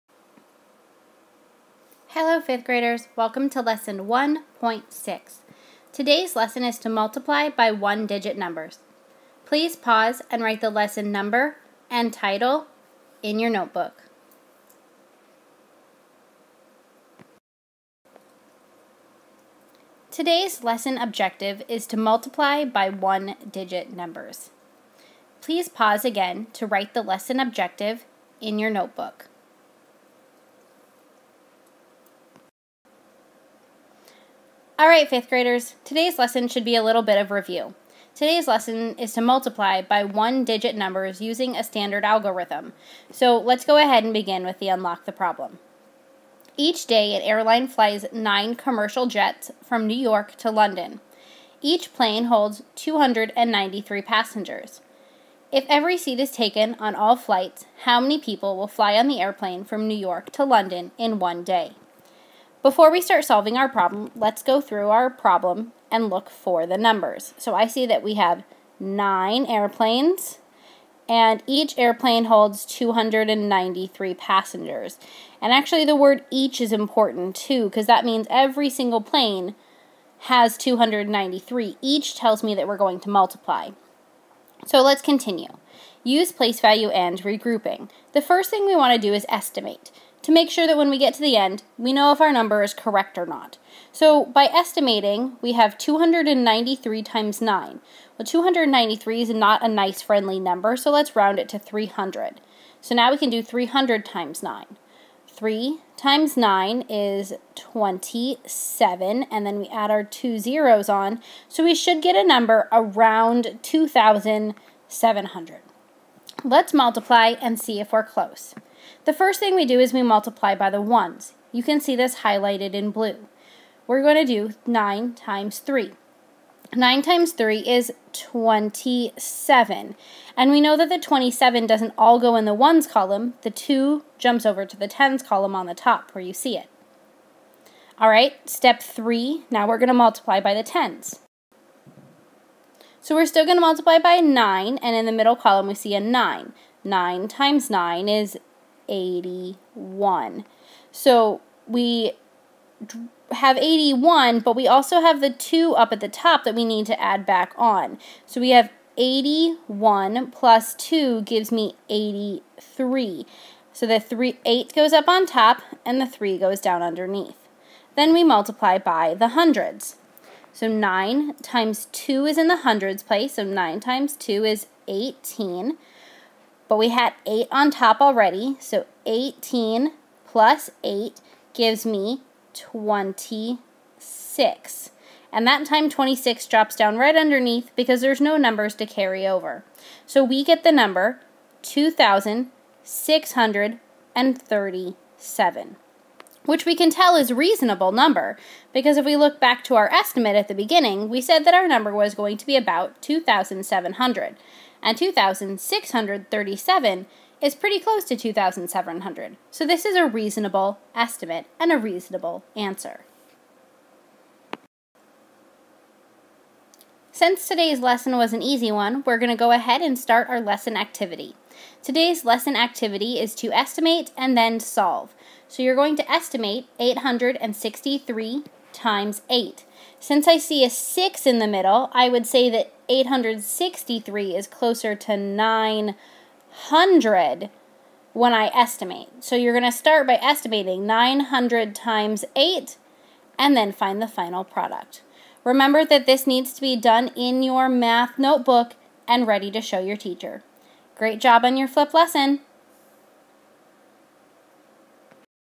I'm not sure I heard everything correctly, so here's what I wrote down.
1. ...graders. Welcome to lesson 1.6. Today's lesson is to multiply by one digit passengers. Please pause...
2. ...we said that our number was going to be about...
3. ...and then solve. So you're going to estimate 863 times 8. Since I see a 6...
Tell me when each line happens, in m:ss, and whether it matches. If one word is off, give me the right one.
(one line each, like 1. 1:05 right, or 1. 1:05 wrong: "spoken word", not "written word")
1. 0:02 wrong: "numbers", not "passengers"
2. 3:21 right
3. 3:44 right.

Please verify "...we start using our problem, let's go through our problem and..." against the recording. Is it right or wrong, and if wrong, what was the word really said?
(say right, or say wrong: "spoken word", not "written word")
wrong: "solving", not "using".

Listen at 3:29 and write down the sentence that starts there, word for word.
So this is a reasonable estimate and a reasonable answer.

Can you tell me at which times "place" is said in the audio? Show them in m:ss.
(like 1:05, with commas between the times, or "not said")
1:26, 2:53.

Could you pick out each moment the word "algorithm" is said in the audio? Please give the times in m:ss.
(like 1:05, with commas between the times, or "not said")
0:42.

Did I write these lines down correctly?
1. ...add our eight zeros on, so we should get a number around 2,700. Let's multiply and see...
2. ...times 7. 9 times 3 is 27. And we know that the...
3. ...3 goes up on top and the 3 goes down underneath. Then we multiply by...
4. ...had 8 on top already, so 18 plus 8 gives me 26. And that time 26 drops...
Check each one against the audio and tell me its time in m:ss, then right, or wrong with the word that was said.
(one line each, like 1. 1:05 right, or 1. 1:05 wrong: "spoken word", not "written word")
1. 1:49 wrong: "two", not "eight"
2. 2:05 wrong: "3", not "7"
3. 2:44 wrong: "8", not "3"
4. 2:56 right.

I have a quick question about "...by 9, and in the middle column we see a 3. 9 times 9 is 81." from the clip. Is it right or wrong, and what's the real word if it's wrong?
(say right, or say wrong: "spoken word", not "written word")
wrong: "9", not "3".